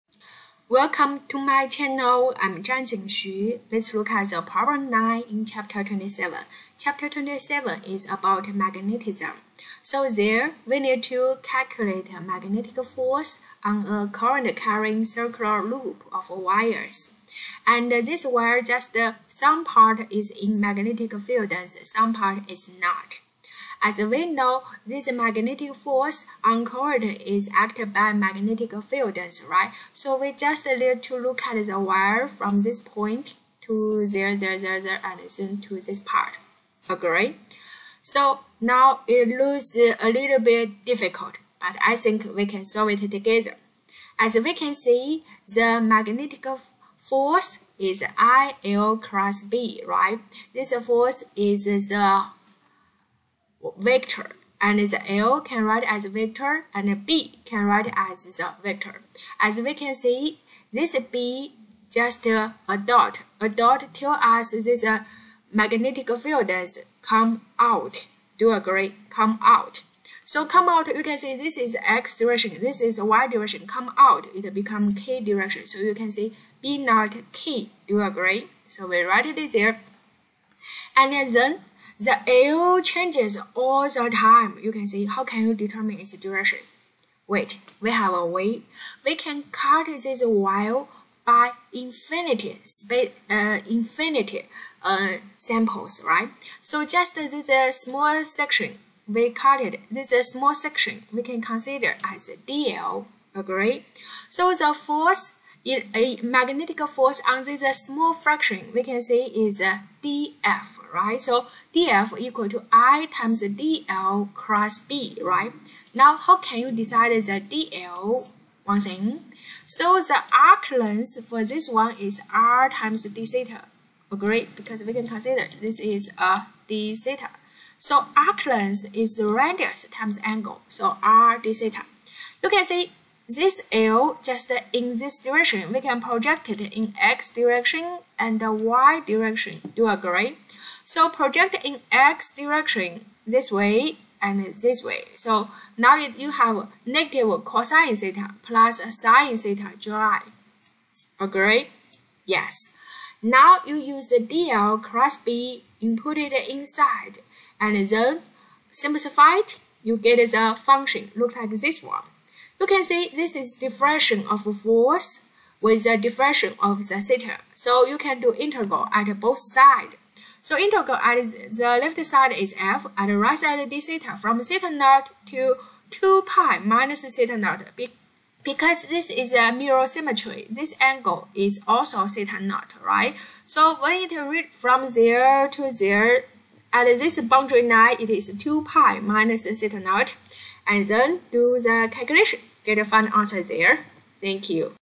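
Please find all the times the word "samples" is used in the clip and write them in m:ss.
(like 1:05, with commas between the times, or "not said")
1:35.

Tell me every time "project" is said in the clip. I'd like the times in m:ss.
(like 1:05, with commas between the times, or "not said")
2:16, 2:21.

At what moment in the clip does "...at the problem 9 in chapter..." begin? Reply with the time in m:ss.
0:04.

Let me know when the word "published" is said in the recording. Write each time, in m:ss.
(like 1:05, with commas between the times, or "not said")
not said.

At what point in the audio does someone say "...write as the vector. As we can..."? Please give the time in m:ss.
0:57.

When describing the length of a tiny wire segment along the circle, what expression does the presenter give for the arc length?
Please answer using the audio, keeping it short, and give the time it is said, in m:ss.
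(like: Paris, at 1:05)
R d theta, at 2:11.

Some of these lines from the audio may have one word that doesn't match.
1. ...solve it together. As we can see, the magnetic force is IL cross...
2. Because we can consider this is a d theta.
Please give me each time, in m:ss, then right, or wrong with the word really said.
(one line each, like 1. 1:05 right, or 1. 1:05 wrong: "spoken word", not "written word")
1. 0:42 right
2. 2:04 right.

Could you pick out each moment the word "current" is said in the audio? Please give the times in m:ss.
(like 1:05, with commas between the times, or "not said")
0:14, 0:26.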